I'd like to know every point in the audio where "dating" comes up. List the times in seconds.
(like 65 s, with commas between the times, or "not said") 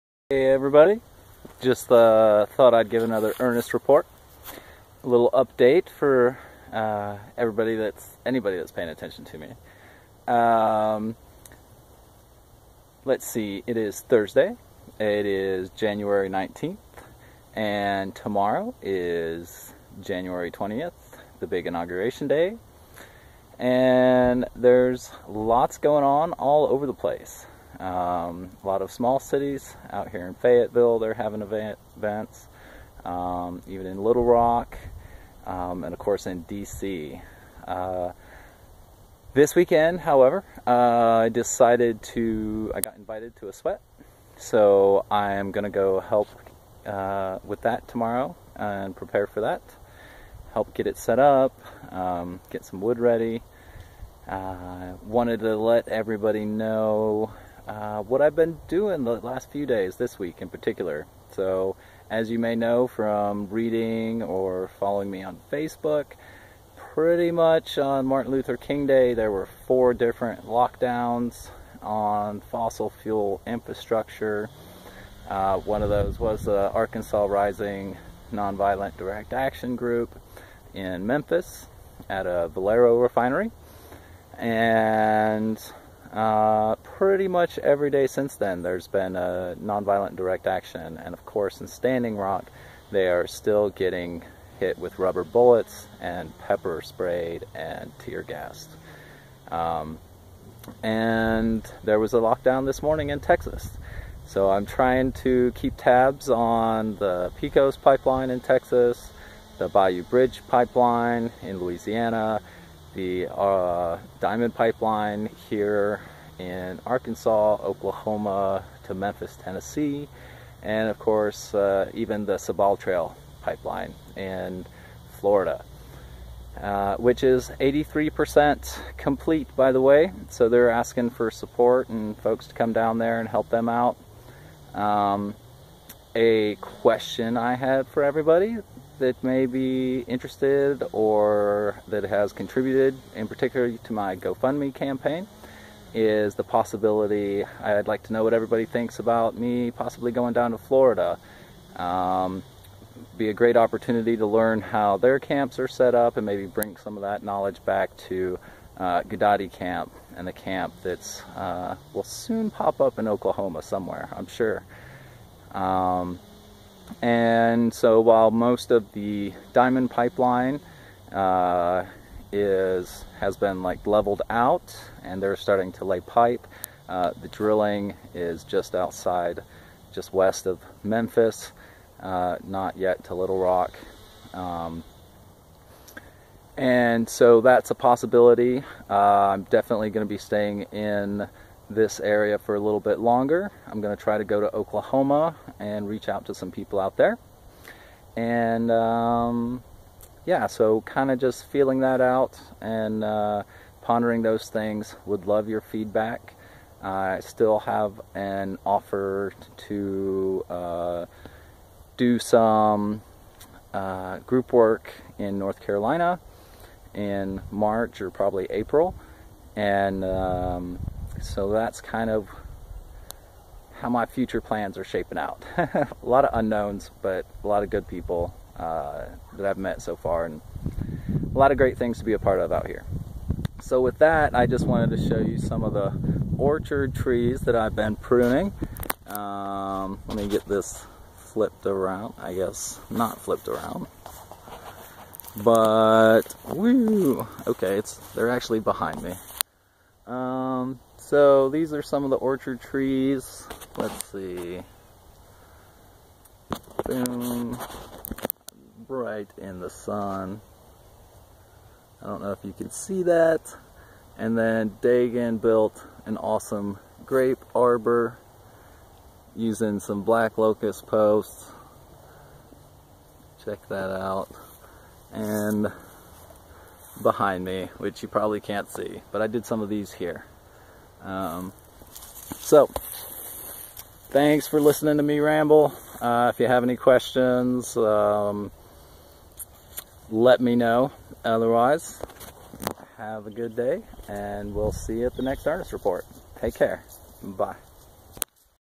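not said.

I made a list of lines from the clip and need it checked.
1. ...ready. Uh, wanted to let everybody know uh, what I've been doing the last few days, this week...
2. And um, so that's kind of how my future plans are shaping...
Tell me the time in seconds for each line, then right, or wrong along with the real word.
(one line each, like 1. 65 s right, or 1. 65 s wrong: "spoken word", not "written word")
1. 52 s right
2. 219 s right.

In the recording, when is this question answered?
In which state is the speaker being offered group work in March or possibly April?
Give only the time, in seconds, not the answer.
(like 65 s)
215 s.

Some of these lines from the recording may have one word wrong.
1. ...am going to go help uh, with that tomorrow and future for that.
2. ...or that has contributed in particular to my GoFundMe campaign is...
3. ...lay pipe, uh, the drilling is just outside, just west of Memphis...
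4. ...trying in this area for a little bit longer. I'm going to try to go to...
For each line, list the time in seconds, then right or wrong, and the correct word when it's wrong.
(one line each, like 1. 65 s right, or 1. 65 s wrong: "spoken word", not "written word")
1. 45 s wrong: "prepare", not "future"
2. 140 s right
3. 175 s right
4. 190 s wrong: "staying", not "trying".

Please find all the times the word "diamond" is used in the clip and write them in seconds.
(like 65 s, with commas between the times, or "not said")
114 s, 169 s.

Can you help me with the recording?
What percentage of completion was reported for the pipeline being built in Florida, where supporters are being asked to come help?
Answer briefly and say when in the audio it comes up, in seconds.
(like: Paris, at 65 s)
83%, at 127 s.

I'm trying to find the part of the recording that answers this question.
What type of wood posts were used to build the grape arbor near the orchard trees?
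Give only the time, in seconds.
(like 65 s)
270 s.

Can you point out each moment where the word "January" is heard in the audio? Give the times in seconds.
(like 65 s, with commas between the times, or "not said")
15 s, 19 s.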